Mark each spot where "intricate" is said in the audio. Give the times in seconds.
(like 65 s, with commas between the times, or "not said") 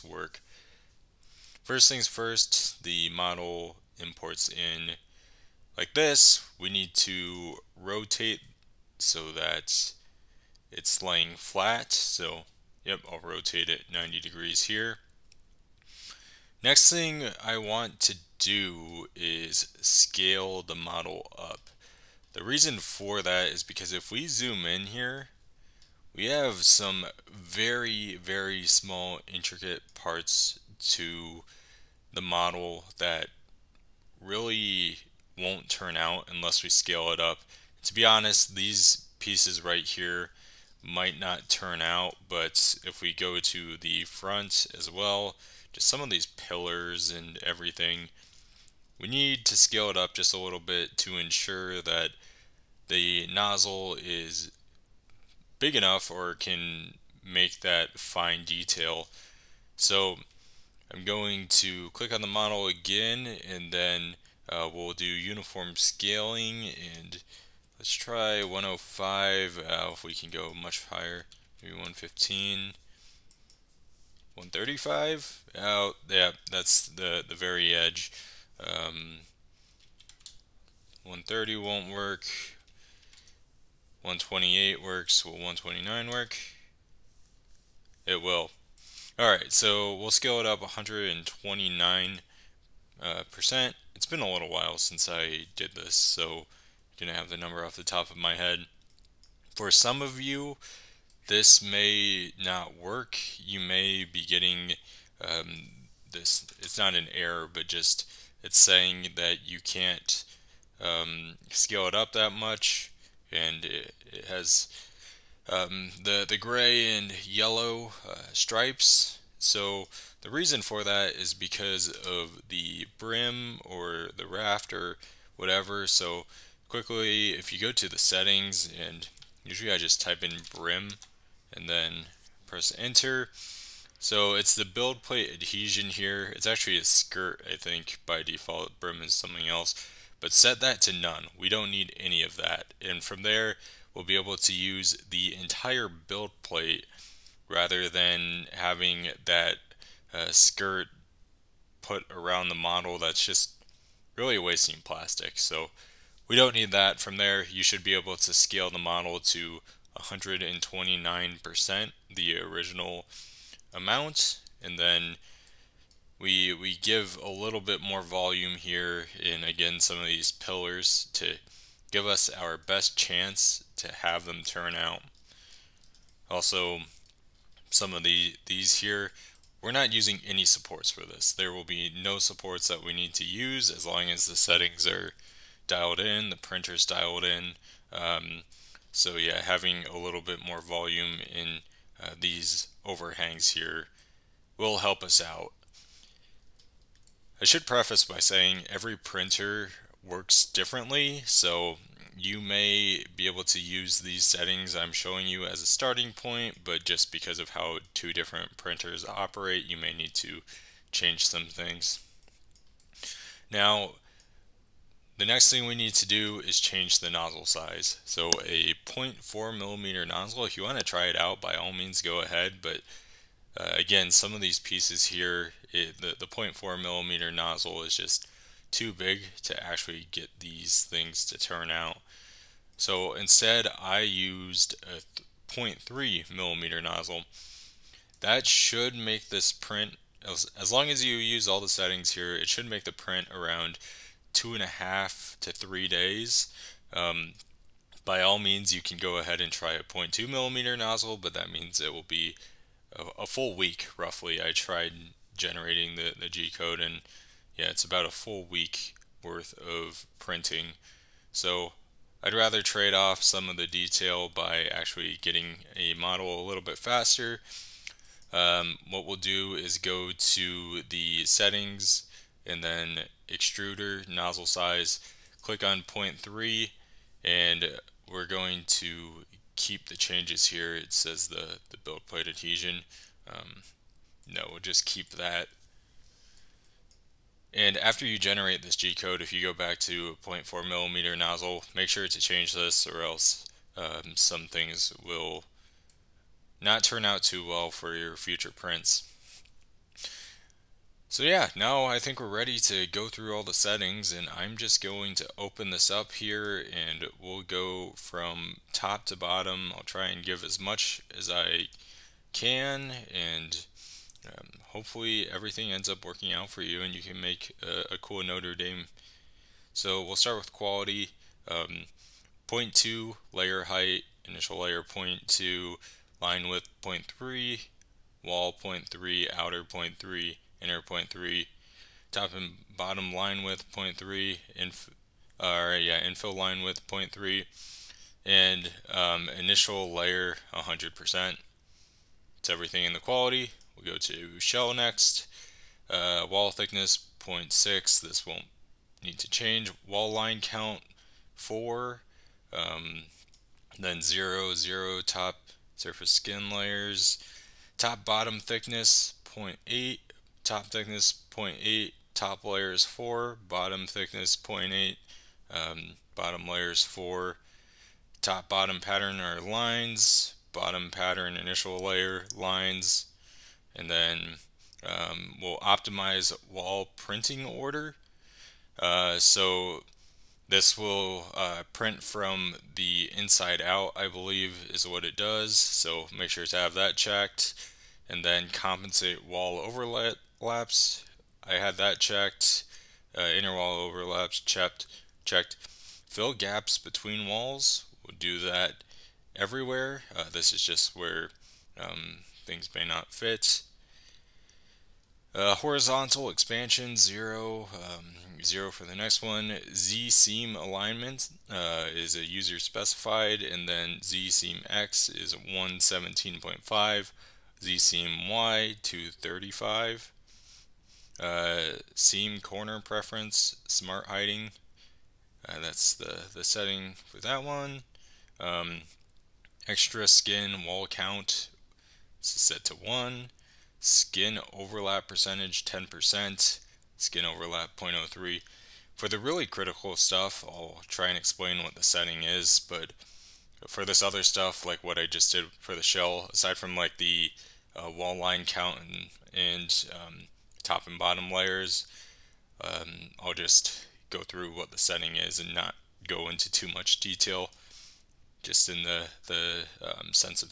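29 s.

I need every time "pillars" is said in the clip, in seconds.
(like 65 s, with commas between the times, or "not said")
46 s, 170 s.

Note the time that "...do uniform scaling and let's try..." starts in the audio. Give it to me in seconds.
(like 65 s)
64 s.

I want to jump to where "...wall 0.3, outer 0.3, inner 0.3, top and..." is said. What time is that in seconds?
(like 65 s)
328 s.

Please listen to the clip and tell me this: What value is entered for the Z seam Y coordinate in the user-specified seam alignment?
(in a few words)
235.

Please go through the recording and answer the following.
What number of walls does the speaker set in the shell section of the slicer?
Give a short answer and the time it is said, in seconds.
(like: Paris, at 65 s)
4, at 349 s.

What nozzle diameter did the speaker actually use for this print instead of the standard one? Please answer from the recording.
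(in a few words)
0.3 mm.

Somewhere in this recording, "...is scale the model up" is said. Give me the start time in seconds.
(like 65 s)
19 s.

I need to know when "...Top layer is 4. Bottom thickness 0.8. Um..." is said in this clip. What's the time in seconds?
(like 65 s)
362 s.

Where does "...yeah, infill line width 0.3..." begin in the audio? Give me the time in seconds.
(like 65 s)
335 s.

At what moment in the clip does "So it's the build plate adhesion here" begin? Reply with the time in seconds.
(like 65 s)
133 s.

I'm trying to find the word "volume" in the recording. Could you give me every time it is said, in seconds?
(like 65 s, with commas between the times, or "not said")
168 s, 190 s.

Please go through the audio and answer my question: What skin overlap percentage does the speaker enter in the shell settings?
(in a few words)
10%.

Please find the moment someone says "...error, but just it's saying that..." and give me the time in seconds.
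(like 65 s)
107 s.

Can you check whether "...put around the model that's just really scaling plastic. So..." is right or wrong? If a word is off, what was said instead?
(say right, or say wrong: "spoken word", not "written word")
wrong: "wasting", not "scaling".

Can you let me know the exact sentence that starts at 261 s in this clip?
So I'd rather trade off some of the detail by actually getting a model a little bit faster.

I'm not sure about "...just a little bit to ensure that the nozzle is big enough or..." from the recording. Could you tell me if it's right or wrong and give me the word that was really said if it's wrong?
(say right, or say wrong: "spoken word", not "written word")
right.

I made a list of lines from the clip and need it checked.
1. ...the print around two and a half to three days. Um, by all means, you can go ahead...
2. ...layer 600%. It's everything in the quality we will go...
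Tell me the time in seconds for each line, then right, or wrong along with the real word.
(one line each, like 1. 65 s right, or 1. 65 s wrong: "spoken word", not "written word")
1. 242 s right
2. 339 s wrong: "100", not "600".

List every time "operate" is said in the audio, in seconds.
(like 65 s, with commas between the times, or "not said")
209 s.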